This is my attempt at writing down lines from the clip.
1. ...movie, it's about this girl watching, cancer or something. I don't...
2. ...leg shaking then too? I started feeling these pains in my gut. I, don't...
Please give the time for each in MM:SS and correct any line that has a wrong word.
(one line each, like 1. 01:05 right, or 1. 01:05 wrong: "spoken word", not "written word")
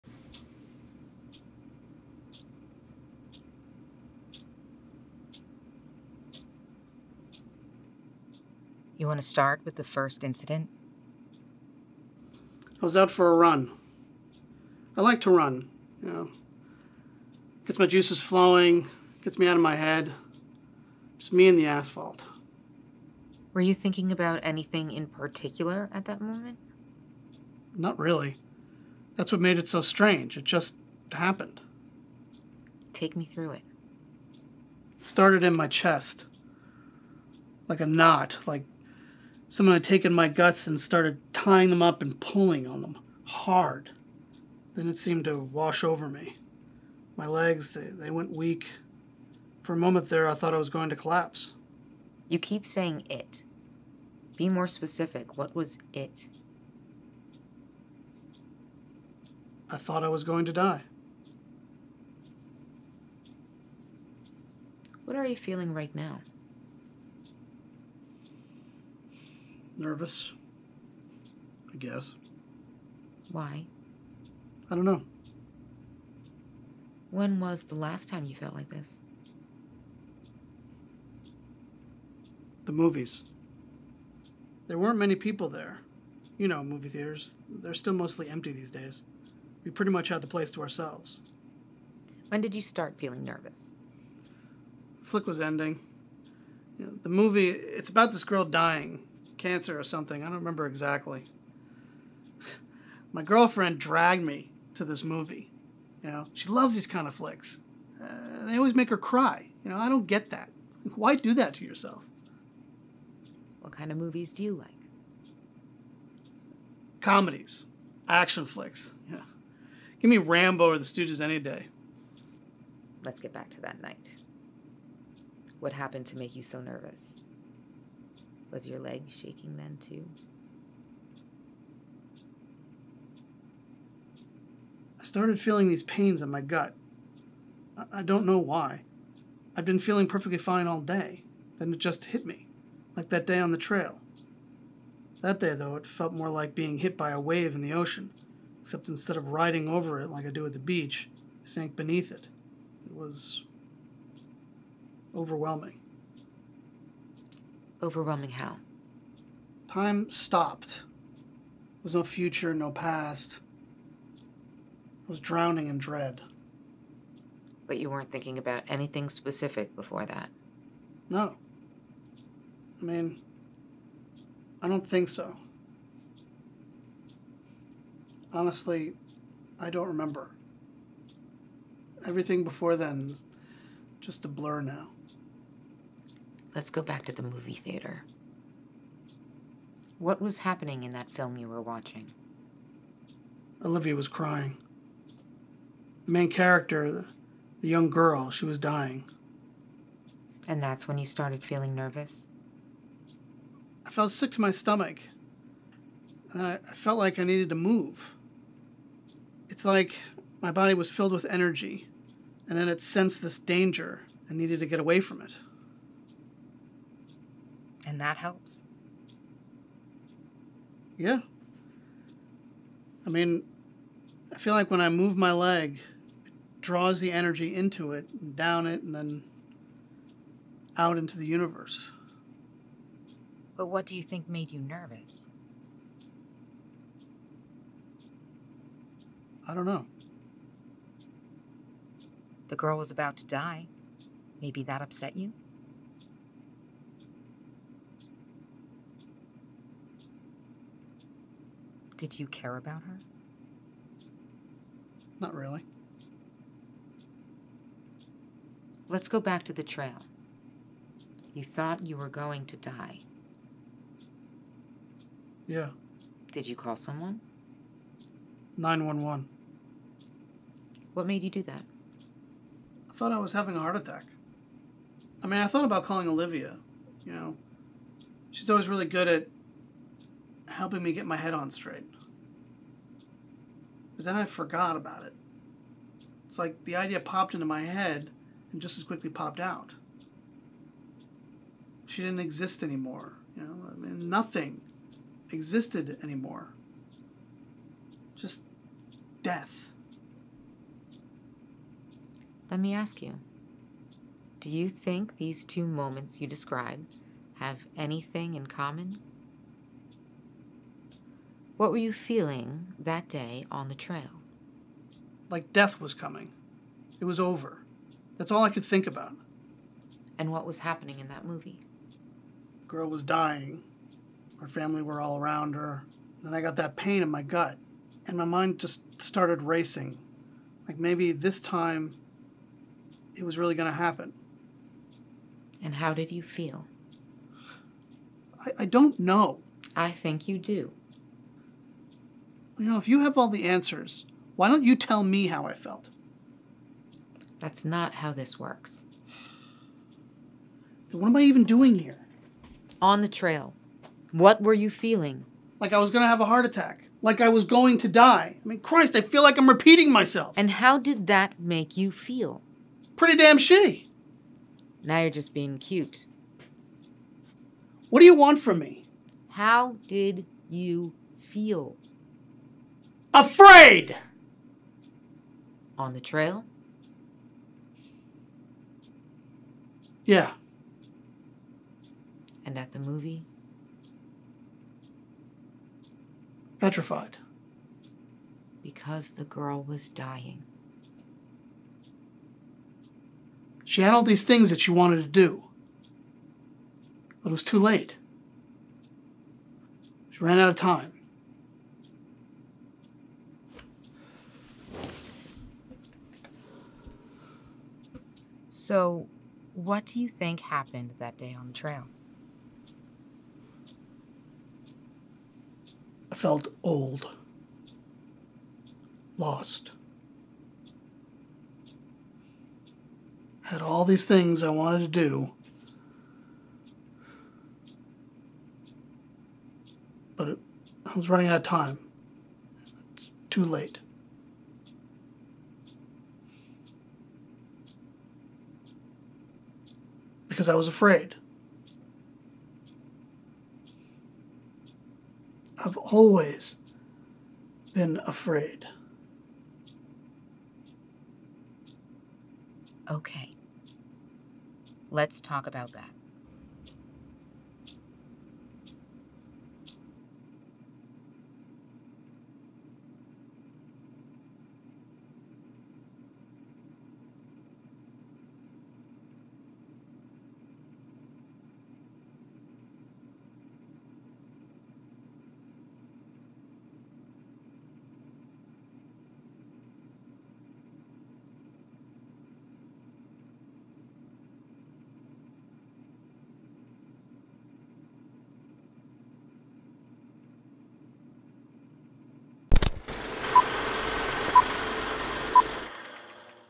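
1. 01:37 wrong: "dying", not "watching"
2. 02:08 right.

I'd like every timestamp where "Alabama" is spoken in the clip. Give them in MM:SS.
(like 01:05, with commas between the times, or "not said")
not said.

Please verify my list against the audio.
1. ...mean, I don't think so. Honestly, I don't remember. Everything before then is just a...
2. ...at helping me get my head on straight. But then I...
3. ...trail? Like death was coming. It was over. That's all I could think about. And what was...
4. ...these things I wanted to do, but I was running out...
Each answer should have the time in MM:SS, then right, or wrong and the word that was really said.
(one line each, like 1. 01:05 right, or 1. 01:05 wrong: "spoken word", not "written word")
1. 02:52 right
2. 04:39 right
3. 05:13 right
4. 07:03 right.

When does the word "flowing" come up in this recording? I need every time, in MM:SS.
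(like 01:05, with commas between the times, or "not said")
00:18.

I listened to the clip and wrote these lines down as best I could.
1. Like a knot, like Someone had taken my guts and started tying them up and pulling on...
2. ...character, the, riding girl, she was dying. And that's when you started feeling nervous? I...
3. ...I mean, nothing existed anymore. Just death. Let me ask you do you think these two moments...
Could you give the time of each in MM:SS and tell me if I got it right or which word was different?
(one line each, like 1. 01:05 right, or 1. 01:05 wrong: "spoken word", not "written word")
1. 00:37 right
2. 03:16 wrong: "young", not "riding"
3. 04:53 right.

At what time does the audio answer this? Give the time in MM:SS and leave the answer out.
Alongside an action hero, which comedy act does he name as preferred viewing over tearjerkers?
02:00.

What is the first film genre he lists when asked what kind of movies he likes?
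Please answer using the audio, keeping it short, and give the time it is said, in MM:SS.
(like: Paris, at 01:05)
Comedies, at 01:57.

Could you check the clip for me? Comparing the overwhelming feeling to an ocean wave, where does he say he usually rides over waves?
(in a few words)
the beach.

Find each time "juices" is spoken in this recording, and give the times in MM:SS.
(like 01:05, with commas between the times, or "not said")
00:17.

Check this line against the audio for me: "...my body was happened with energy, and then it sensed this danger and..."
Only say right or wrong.
wrong.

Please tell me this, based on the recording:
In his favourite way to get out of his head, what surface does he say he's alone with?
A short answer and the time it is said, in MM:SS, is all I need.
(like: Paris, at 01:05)
asphalt, at 00:21.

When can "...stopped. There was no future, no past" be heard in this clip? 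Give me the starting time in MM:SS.
02:40.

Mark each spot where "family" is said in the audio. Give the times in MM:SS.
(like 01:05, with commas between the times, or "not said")
05:24.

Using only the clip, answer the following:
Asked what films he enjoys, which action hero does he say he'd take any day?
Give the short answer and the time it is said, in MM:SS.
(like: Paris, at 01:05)
Rambo, at 02:00.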